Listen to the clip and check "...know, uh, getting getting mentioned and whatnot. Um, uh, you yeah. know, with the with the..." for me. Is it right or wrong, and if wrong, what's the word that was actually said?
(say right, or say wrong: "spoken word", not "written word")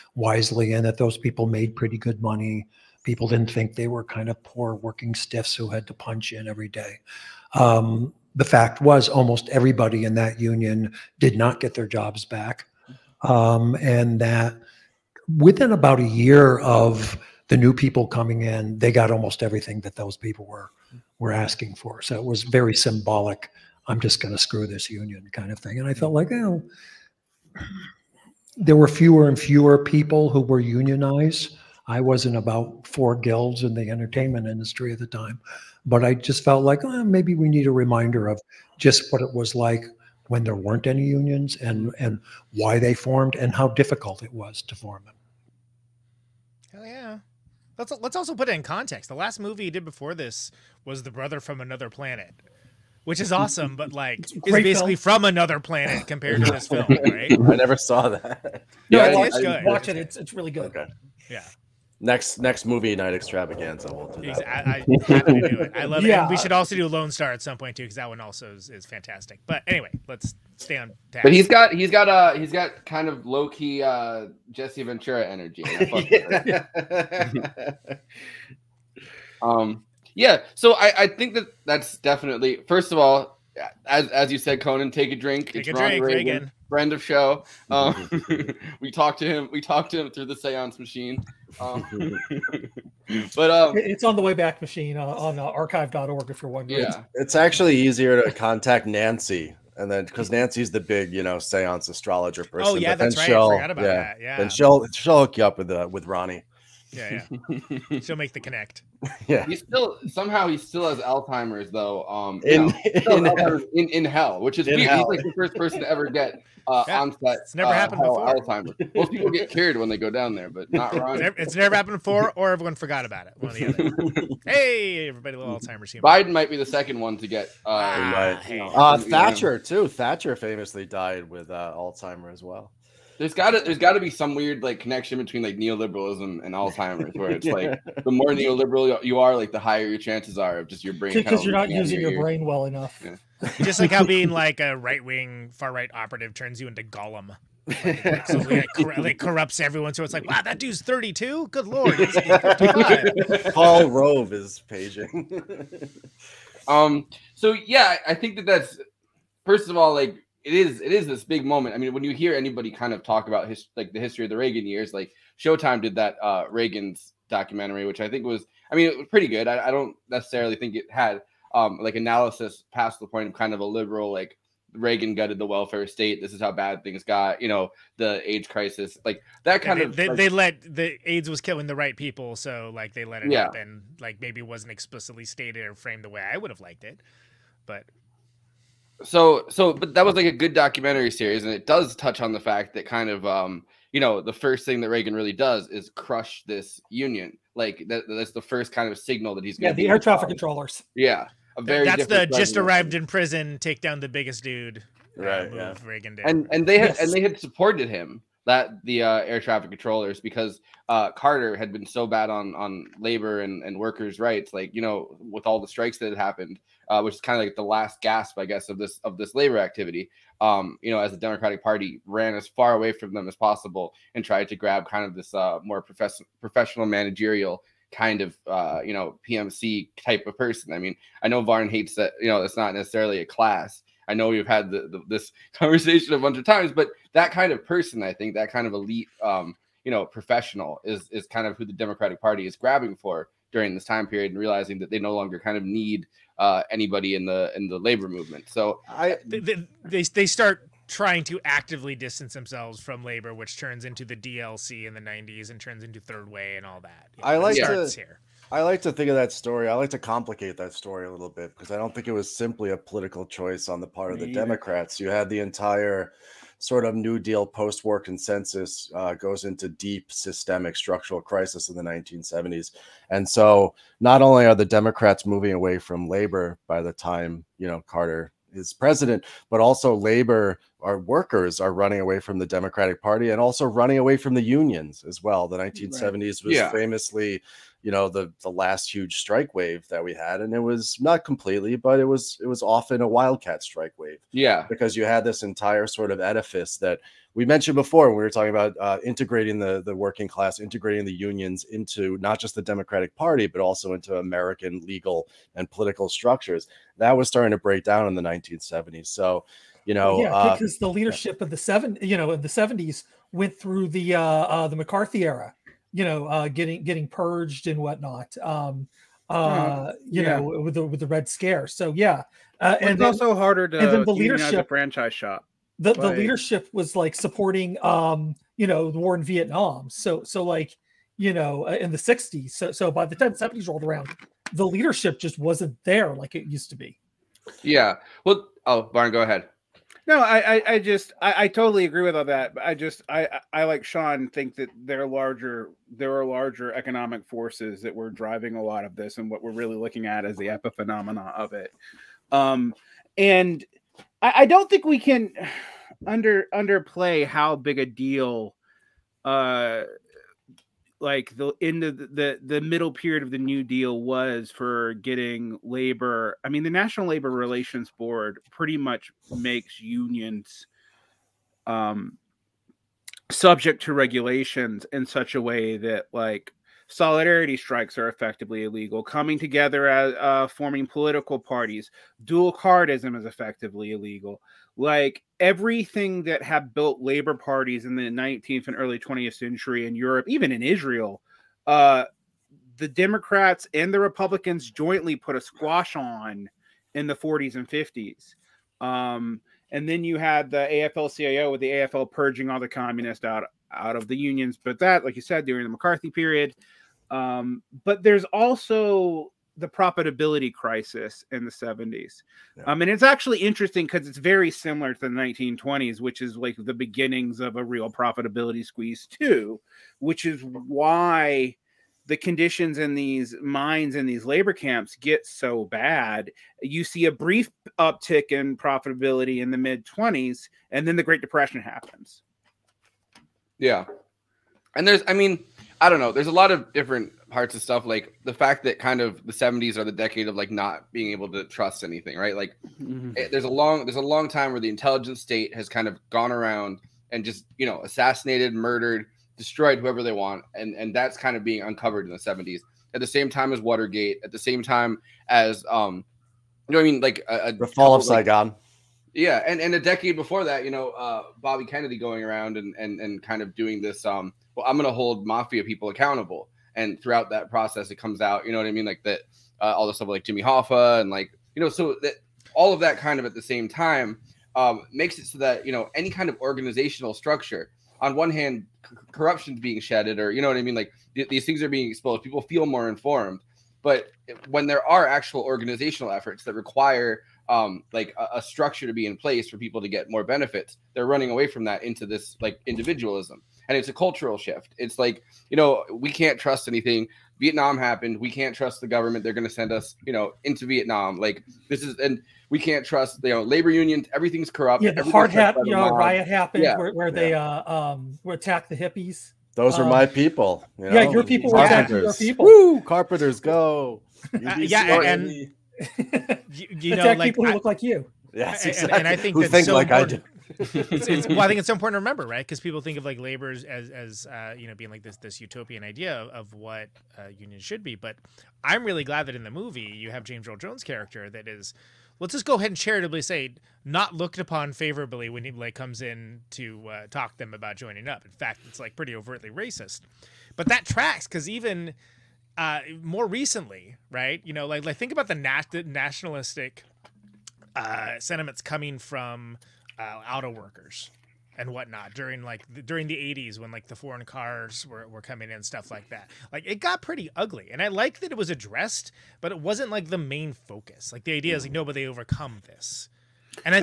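wrong: "purged", not "mentioned".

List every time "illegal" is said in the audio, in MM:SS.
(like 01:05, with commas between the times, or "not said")
06:18, 06:23.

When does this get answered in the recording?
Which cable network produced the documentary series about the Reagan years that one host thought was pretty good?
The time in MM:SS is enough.
02:45.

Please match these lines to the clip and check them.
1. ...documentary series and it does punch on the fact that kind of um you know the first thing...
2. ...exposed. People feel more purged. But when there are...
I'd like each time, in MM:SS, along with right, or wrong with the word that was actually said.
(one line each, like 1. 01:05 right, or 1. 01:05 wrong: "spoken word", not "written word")
1. 03:10 wrong: "touch", not "punch"
2. 08:01 wrong: "informed", not "purged".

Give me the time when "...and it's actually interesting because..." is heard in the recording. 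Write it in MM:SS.
06:52.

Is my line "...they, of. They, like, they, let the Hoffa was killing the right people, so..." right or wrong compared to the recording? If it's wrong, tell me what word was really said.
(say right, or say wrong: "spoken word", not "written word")
wrong: "AIDS", not "Hoffa".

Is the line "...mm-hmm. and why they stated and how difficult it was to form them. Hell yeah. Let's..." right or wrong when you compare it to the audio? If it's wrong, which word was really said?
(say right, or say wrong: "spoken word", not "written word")
wrong: "formed", not "stated".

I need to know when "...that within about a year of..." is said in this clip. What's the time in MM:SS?
00:14.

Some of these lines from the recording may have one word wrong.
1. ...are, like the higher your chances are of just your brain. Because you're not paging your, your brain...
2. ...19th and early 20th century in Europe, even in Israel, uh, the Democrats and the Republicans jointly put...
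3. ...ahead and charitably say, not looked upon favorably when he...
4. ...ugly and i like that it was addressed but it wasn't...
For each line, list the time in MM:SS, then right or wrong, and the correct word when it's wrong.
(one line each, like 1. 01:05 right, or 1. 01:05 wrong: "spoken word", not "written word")
1. 02:19 wrong: "using", not "paging"
2. 06:28 right
3. 08:52 right
4. 09:17 right.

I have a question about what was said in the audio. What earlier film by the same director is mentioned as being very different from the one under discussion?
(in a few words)
The Brother from Another Planet.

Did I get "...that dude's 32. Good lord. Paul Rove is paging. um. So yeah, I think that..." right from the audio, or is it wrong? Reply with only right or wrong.
right.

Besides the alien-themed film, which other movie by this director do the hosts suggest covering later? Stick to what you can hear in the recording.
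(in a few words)
Lone Star.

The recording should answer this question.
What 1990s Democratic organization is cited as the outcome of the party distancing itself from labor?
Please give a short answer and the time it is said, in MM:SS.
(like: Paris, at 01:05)
DLC, at 04:14.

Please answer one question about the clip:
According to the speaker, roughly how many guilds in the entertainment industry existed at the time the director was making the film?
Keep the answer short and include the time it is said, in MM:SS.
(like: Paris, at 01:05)
4, at 00:32.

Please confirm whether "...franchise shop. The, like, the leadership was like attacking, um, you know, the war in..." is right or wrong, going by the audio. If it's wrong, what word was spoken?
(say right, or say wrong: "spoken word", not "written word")
wrong: "supporting", not "attacking".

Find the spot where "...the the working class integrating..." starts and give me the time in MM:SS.
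04:59.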